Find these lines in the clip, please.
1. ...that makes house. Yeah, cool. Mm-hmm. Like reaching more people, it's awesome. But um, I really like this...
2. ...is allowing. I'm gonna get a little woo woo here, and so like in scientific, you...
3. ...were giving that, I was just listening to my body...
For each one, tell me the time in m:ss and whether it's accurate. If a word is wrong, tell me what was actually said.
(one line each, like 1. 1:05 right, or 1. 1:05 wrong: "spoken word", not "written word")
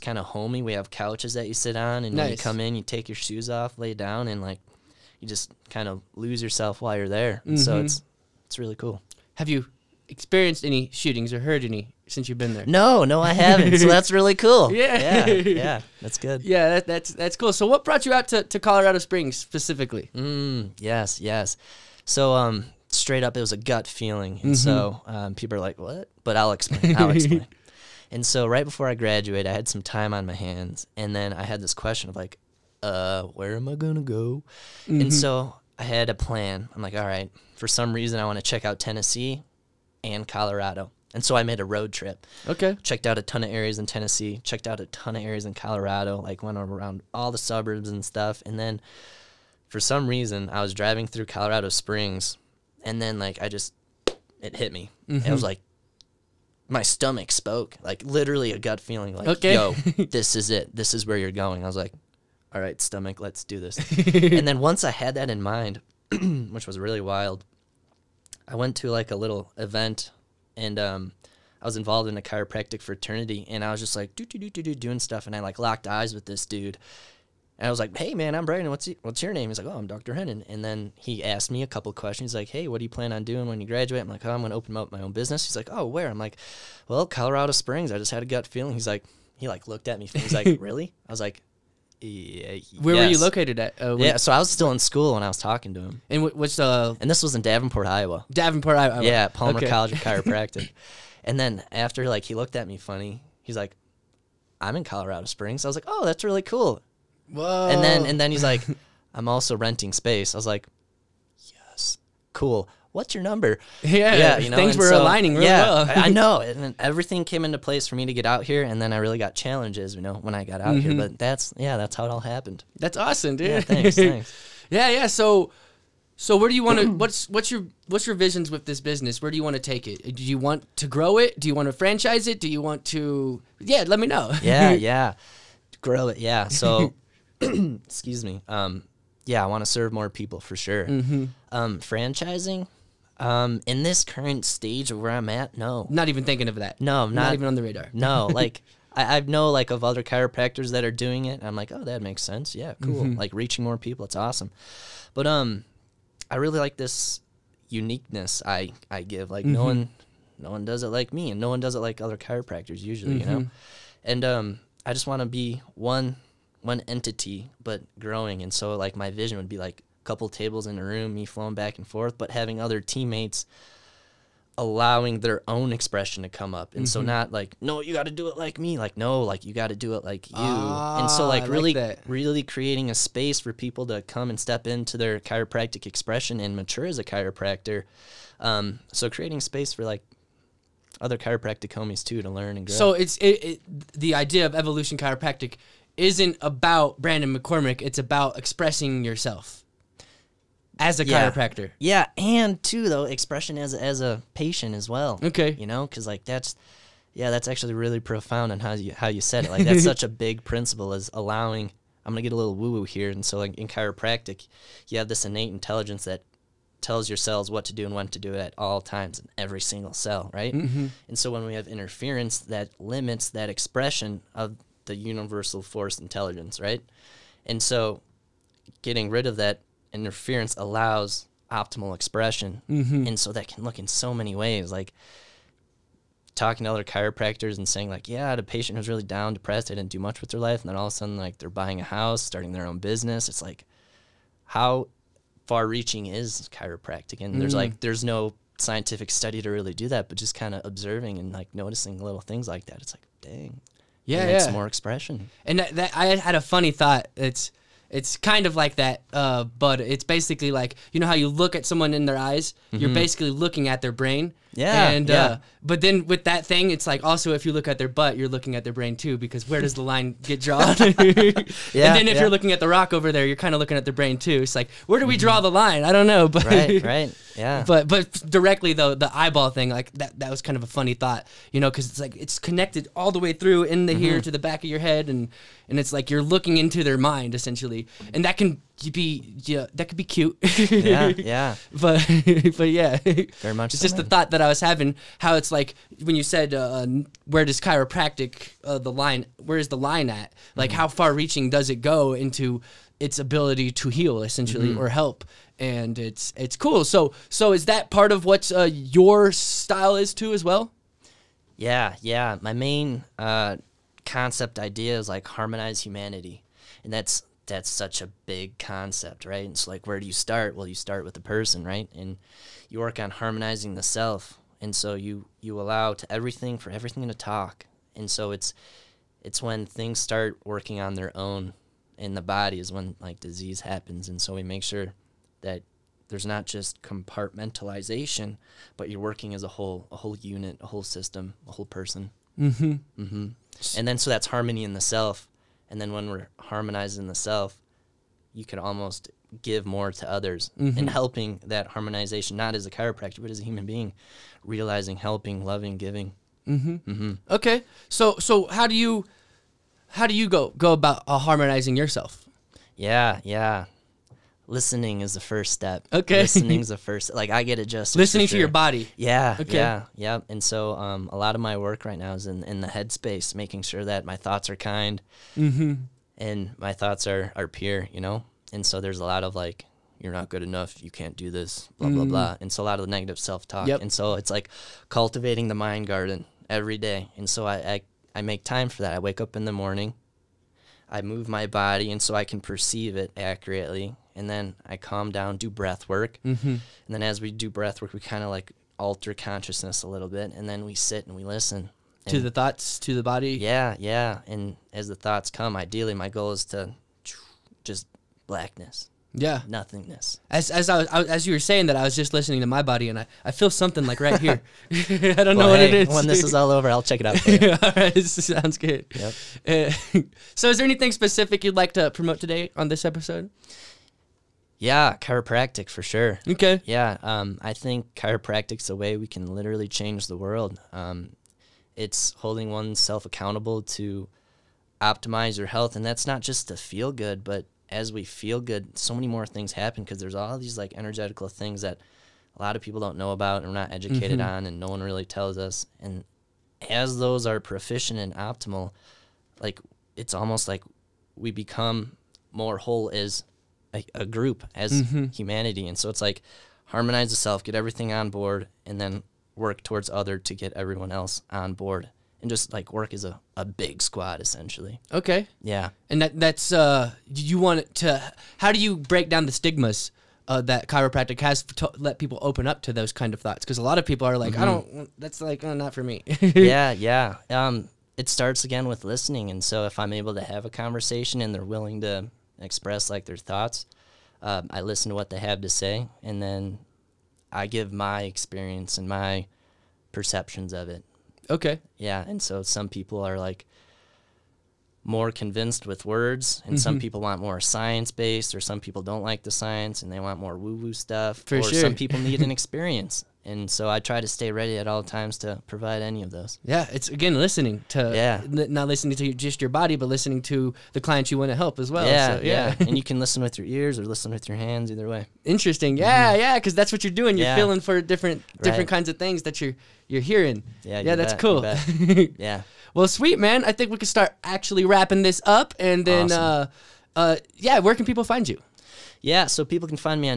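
1. 2:31 wrong: "sense", not "house"
2. 3:30 wrong: "chiropractic", not "scientific"
3. 6:51 wrong: "saying", not "giving".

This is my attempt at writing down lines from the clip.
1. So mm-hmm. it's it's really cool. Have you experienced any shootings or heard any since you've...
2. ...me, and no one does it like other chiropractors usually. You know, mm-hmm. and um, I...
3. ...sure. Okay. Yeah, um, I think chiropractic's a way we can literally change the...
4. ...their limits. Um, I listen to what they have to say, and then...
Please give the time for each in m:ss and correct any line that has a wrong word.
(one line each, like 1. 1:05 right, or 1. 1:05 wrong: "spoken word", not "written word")
1. 0:07 right
2. 2:41 right
3. 7:05 right
4. 8:03 wrong: "thoughts", not "limits".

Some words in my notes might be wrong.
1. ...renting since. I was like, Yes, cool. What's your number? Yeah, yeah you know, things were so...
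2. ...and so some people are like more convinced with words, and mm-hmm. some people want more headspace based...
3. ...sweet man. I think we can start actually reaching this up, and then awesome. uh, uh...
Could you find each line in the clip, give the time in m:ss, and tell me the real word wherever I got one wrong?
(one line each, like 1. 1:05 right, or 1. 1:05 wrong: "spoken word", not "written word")
1. 1:49 wrong: "space", not "since"
2. 8:12 wrong: "science", not "headspace"
3. 8:42 wrong: "wrapping", not "reaching".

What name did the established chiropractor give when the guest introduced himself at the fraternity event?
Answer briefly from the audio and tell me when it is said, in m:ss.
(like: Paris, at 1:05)
Dr. Hennon, at 1:19.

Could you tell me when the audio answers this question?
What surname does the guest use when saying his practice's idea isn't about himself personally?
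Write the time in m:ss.
3:17.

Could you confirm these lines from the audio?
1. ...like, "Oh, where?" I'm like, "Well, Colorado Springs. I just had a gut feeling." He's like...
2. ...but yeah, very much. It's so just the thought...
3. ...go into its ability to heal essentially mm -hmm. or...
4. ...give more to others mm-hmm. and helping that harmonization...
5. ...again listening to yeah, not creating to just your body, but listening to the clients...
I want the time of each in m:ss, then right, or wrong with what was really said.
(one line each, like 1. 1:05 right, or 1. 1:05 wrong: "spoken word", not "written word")
1. 1:25 right
2. 4:52 right
3. 5:01 right
4. 5:49 right
5. 8:26 wrong: "listening", not "creating".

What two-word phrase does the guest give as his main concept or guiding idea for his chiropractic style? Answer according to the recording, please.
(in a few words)
Harmonize humanity.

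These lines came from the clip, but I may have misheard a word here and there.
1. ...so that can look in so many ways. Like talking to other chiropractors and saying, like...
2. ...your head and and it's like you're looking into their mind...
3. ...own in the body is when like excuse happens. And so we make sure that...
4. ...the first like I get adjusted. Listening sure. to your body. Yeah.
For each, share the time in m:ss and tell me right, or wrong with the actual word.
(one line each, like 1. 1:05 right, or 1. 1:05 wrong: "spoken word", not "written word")
1. 3:53 right
2. 4:44 right
3. 5:31 wrong: "disease", not "excuse"
4. 6:06 right.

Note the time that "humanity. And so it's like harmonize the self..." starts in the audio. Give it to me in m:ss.
7:35.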